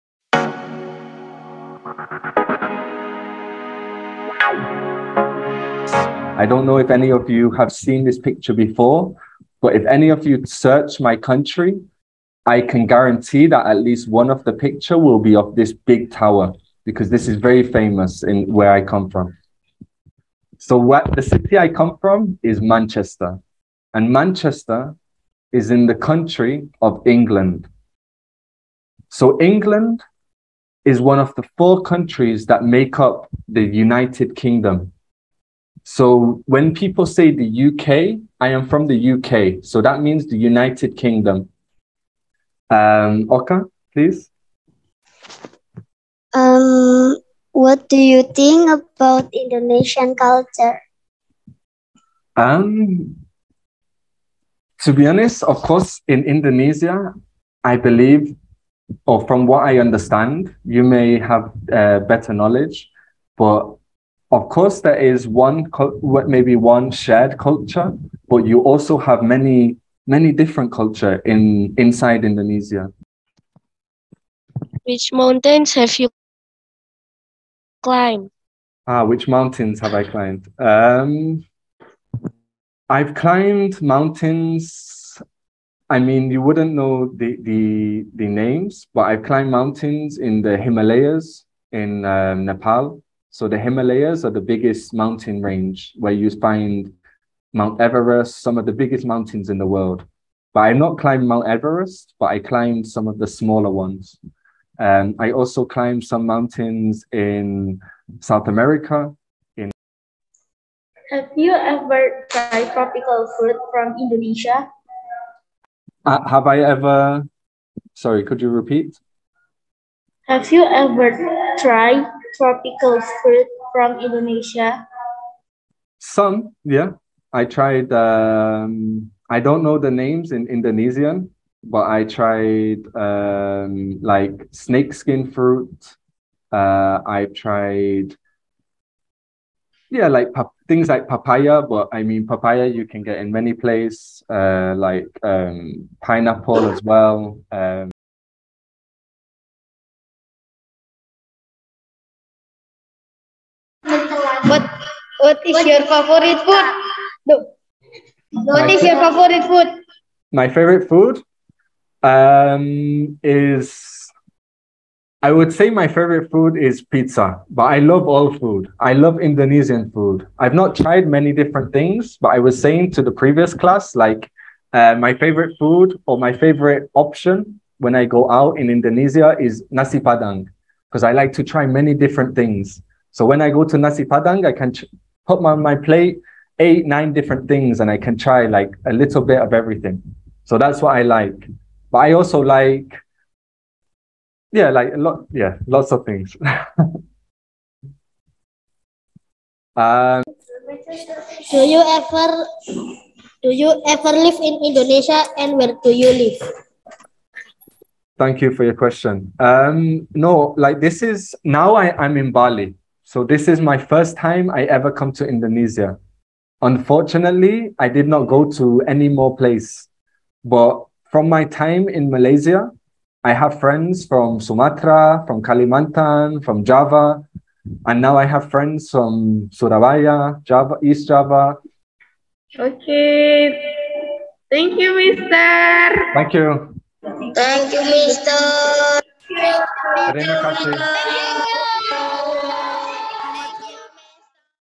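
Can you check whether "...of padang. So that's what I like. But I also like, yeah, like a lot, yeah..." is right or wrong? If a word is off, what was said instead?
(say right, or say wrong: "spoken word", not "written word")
wrong: "everything", not "padang".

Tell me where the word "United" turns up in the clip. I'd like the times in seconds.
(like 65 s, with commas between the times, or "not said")
33 s, 40 s.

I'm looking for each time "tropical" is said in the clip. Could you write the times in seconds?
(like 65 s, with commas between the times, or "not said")
112 s, 122 s.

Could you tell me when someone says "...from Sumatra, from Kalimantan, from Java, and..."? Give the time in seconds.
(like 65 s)
224 s.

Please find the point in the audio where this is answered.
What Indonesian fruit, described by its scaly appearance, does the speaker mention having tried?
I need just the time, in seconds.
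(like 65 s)
134 s.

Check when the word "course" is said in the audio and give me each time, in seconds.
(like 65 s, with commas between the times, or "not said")
55 s, 64 s.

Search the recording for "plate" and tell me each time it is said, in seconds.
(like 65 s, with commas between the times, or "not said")
185 s.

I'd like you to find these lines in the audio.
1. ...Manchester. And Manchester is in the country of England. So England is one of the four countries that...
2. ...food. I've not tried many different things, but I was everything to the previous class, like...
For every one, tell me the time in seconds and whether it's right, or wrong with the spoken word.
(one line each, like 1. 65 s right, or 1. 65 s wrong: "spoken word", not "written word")
1. 22 s right
2. 169 s wrong: "saying", not "everything".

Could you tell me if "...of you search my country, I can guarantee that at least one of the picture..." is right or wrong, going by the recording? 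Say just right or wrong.
right.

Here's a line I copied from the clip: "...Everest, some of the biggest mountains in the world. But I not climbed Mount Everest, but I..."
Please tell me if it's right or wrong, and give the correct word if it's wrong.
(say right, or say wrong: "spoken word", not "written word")
right.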